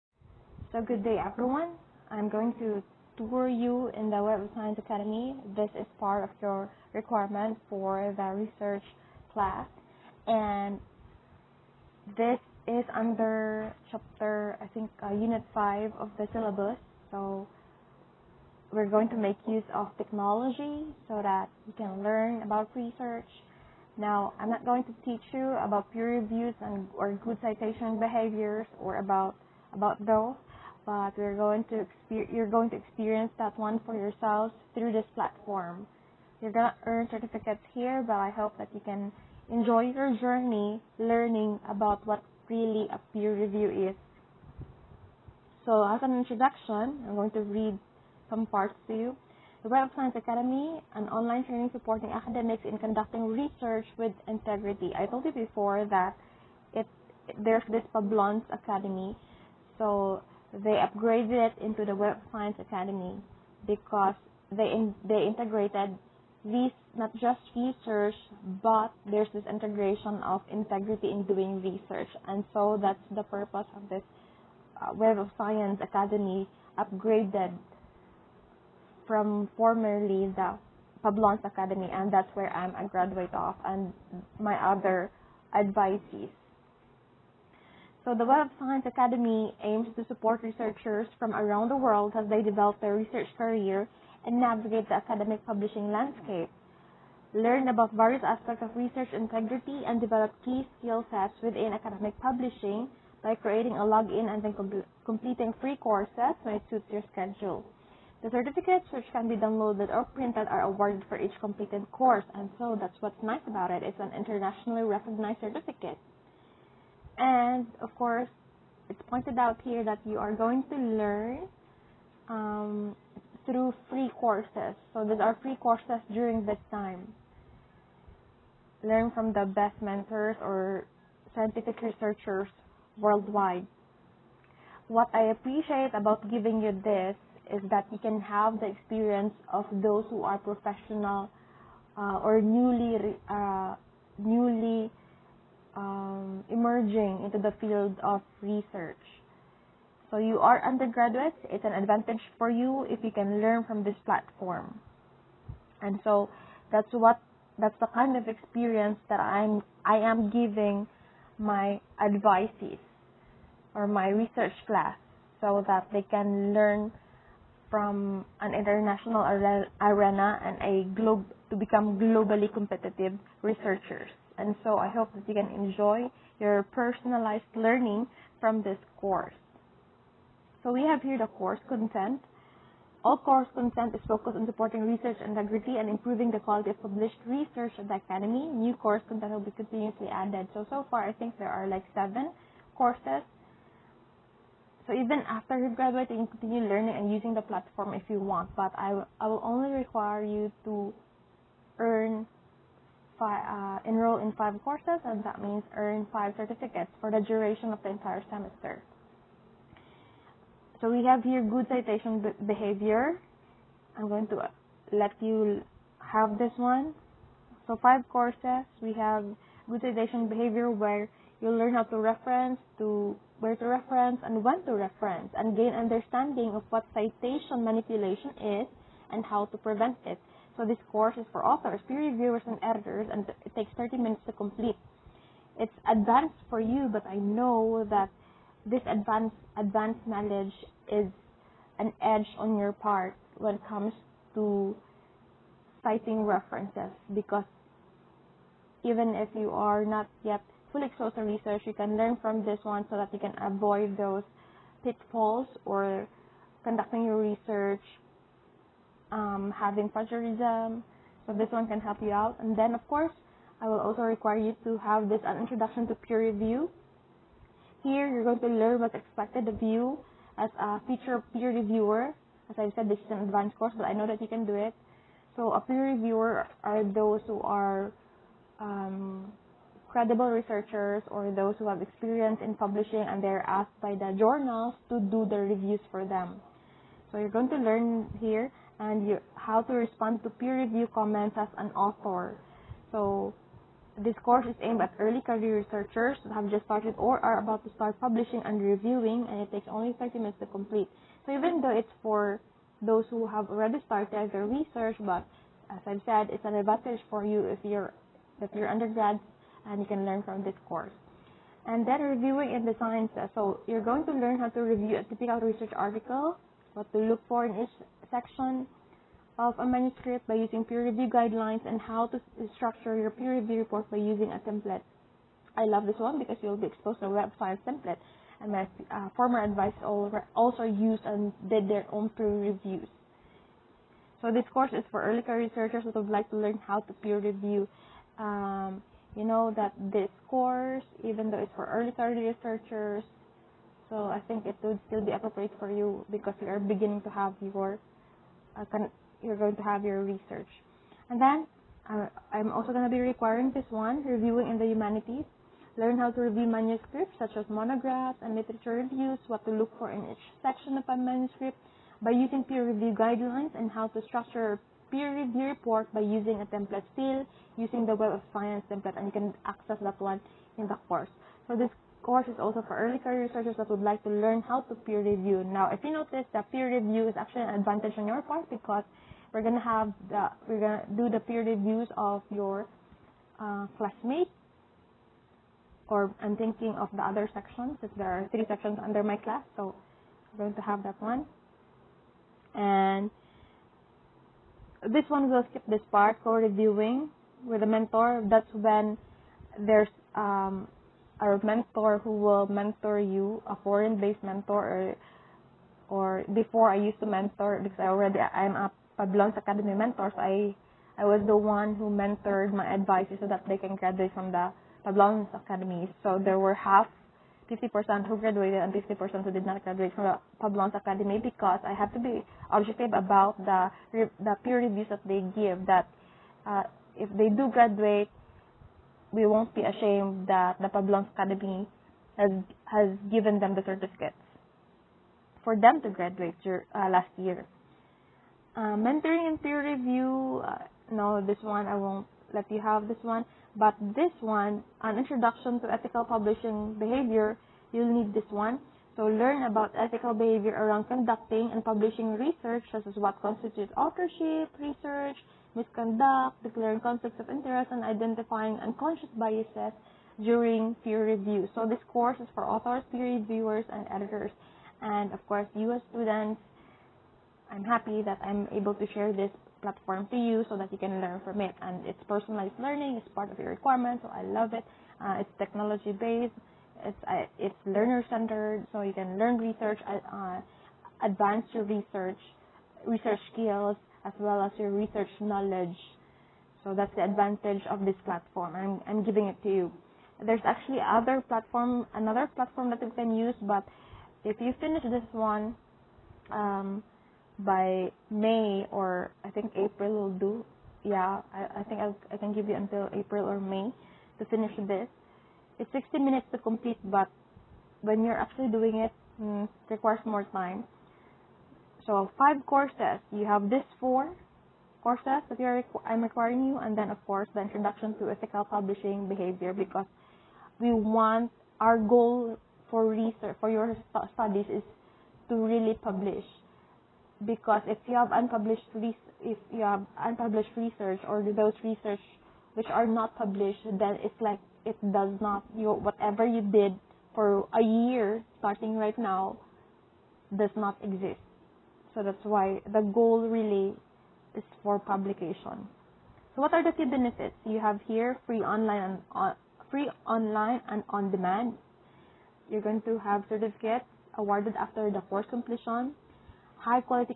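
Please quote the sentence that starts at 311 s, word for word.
And then reviewing in the sciences.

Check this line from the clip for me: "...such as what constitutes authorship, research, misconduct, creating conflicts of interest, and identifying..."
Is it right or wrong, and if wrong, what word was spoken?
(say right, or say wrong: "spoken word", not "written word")
wrong: "declaring", not "creating".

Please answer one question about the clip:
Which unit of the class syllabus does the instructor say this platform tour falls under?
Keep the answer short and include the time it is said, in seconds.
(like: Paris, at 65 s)
Unit 5, at 15 s.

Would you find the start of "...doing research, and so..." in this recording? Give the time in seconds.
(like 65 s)
71 s.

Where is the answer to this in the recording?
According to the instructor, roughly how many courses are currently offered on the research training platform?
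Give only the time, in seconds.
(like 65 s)
191 s.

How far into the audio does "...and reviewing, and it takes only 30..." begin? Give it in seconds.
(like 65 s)
298 s.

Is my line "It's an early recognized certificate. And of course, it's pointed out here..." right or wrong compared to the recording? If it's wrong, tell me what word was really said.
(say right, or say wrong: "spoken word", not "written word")
wrong: "internationally", not "early".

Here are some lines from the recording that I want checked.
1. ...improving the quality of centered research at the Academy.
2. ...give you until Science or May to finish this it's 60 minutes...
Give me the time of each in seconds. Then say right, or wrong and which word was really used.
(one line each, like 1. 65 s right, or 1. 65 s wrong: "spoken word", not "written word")
1. 185 s wrong: "published", not "centered"
2. 502 s wrong: "April", not "Science".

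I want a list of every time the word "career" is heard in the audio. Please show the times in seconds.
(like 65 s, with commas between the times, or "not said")
93 s, 295 s, 335 s, 341 s, 372 s.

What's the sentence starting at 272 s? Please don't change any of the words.
As I said, this is an advanced course, but I know that you can do it.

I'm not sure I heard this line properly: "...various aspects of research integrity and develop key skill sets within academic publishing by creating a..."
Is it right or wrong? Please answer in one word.
right.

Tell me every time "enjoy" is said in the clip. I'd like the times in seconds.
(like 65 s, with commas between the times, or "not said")
39 s, 175 s.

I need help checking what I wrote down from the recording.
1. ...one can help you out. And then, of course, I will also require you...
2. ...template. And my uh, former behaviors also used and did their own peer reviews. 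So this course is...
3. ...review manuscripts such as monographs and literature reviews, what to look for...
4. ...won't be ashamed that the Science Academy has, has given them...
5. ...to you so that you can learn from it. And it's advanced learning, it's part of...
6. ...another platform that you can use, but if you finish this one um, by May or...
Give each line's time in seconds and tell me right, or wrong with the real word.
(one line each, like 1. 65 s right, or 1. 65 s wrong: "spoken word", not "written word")
1. 261 s right
2. 327 s wrong: "advisors", not "behaviors"
3. 356 s right
4. 429 s wrong: "Publons", not "Science"
5. 470 s wrong: "personalized", not "advanced"
6. 491 s right.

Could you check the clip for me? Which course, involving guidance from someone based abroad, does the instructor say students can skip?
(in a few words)
Co-reviewing with a mentor.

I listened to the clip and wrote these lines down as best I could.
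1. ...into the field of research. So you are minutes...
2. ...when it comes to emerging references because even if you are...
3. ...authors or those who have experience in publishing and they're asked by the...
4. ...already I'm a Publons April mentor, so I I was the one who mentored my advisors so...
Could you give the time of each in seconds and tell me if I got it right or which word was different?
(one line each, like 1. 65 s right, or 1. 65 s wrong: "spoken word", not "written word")
1. 147 s wrong: "undergraduates", not "minutes"
2. 243 s wrong: "citing", not "emerging"
3. 280 s wrong: "researchers", not "authors"
4. 407 s wrong: "Academy", not "April".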